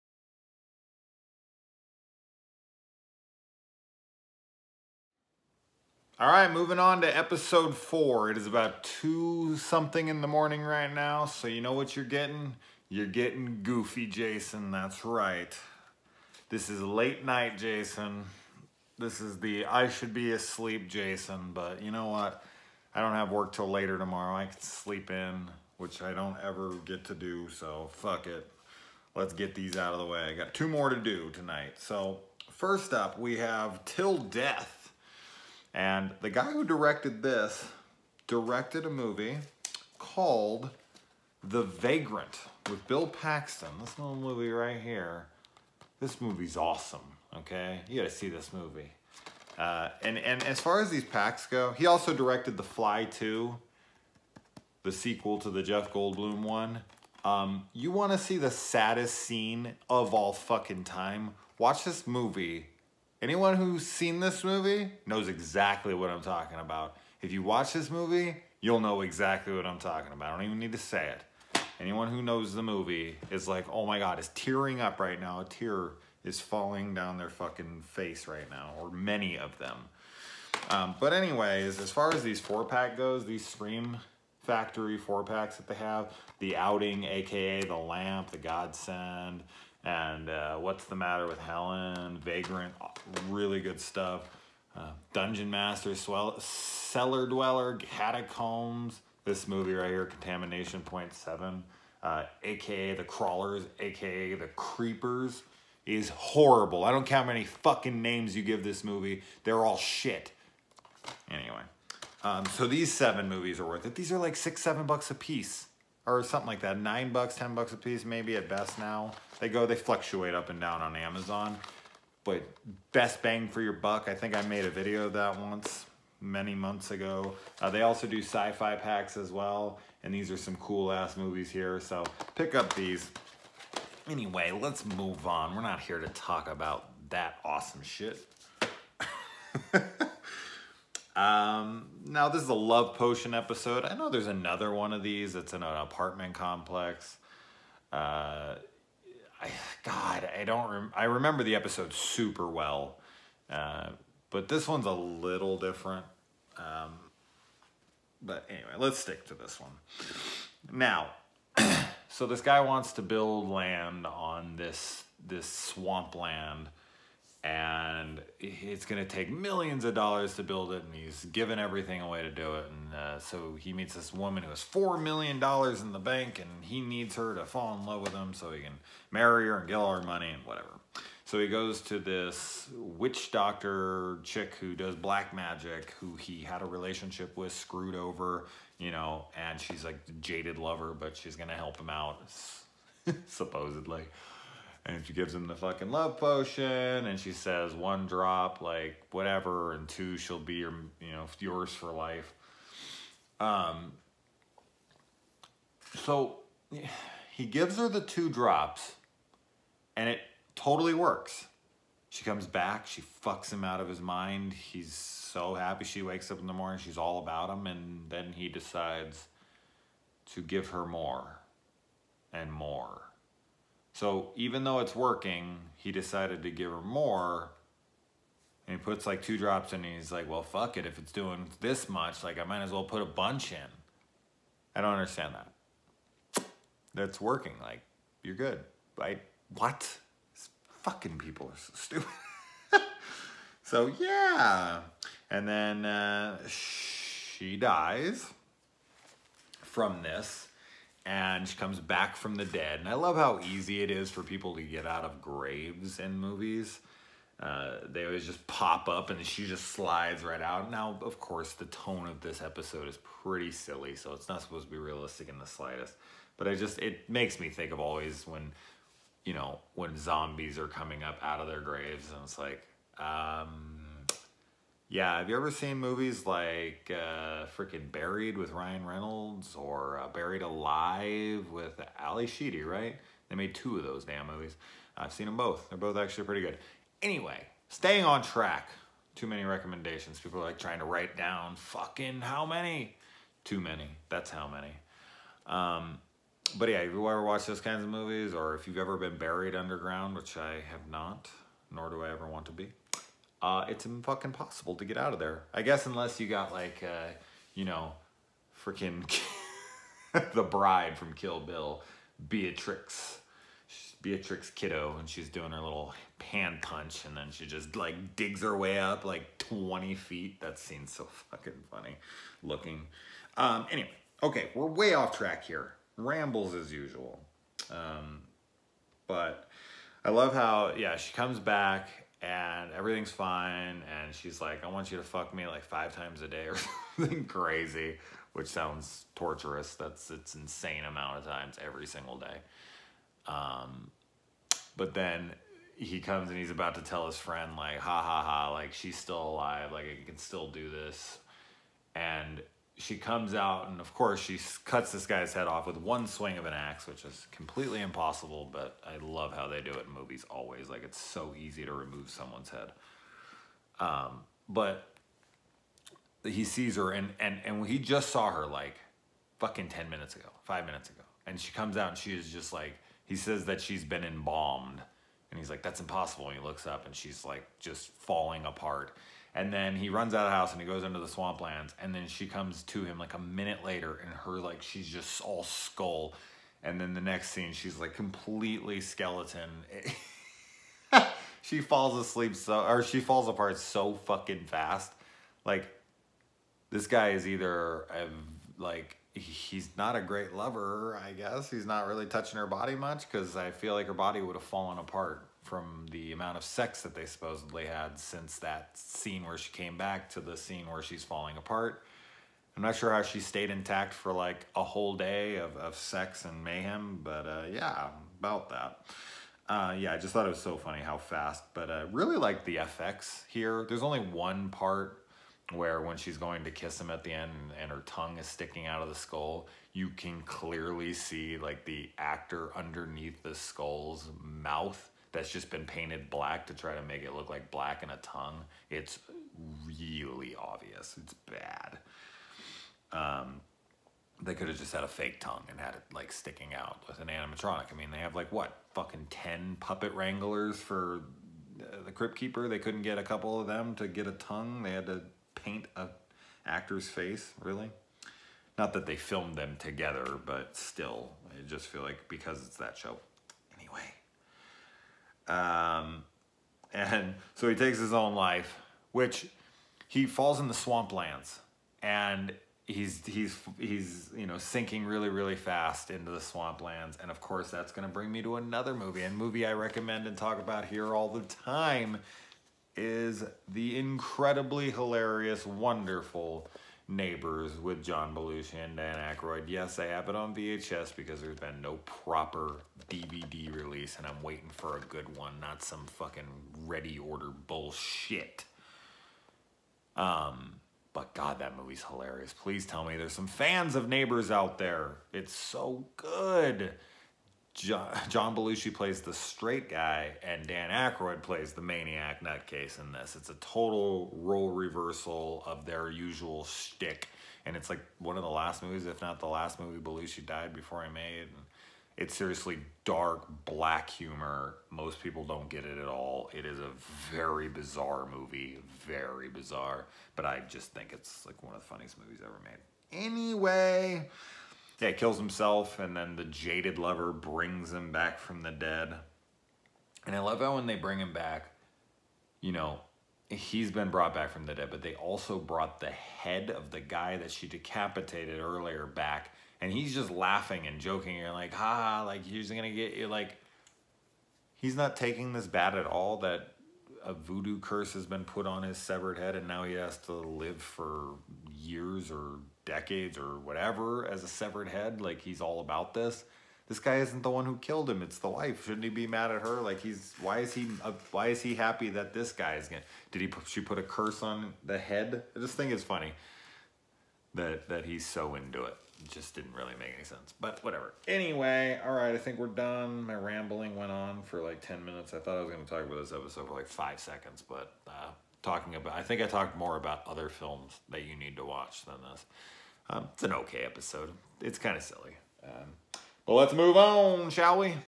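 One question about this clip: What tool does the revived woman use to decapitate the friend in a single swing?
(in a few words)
An axe.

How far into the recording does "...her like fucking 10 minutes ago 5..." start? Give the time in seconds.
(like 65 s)
368 s.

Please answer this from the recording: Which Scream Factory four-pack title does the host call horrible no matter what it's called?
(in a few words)
Contamination Point 7.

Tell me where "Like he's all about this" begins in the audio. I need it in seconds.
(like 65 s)
565 s.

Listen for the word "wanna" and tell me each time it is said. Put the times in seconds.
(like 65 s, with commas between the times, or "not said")
57 s.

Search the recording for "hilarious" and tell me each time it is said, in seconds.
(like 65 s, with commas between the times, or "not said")
484 s, 501 s.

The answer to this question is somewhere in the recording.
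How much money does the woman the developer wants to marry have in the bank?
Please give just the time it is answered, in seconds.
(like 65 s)
174 s.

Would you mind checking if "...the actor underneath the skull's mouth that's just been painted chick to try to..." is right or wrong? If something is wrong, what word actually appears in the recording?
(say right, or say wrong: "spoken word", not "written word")
wrong: "black", not "chick".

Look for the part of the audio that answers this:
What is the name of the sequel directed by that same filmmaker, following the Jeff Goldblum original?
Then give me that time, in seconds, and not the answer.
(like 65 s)
52 s.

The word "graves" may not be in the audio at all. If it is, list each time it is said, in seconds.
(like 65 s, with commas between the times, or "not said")
255 s, 271 s.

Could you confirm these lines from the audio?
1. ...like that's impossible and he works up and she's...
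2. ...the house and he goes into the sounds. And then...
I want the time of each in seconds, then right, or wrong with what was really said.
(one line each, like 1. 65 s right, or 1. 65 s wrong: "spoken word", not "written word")
1. 375 s wrong: "looks", not "works"
2. 380 s wrong: "swamplands", not "sounds".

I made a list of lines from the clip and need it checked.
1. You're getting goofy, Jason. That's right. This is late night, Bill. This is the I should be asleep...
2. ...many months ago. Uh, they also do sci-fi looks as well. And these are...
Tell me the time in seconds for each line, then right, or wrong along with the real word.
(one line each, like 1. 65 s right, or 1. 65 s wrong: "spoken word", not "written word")
1. 12 s wrong: "Jason", not "Bill"
2. 126 s wrong: "packs", not "looks".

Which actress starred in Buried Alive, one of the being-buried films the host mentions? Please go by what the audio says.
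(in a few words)
Ally Sheedy.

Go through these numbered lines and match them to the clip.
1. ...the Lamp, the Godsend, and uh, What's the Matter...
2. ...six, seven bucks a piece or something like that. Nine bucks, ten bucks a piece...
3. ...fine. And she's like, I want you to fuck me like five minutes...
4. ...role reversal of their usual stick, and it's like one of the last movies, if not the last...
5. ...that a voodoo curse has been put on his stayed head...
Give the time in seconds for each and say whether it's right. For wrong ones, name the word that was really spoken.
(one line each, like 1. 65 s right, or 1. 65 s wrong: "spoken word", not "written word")
1. 87 s right
2. 114 s right
3. 333 s wrong: "times", not "minutes"
4. 514 s wrong: "shtick", not "stick"
5. 556 s wrong: "severed", not "stayed".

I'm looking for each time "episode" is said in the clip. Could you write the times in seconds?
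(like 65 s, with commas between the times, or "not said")
7 s, 143 s, 151 s, 262 s, 586 s, 593 s.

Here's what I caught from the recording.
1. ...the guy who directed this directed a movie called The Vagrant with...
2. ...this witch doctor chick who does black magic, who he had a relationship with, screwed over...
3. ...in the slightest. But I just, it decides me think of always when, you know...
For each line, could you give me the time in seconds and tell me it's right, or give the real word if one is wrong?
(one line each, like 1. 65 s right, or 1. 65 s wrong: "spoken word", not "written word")
1. 36 s right
2. 181 s right
3. 265 s wrong: "makes", not "decides".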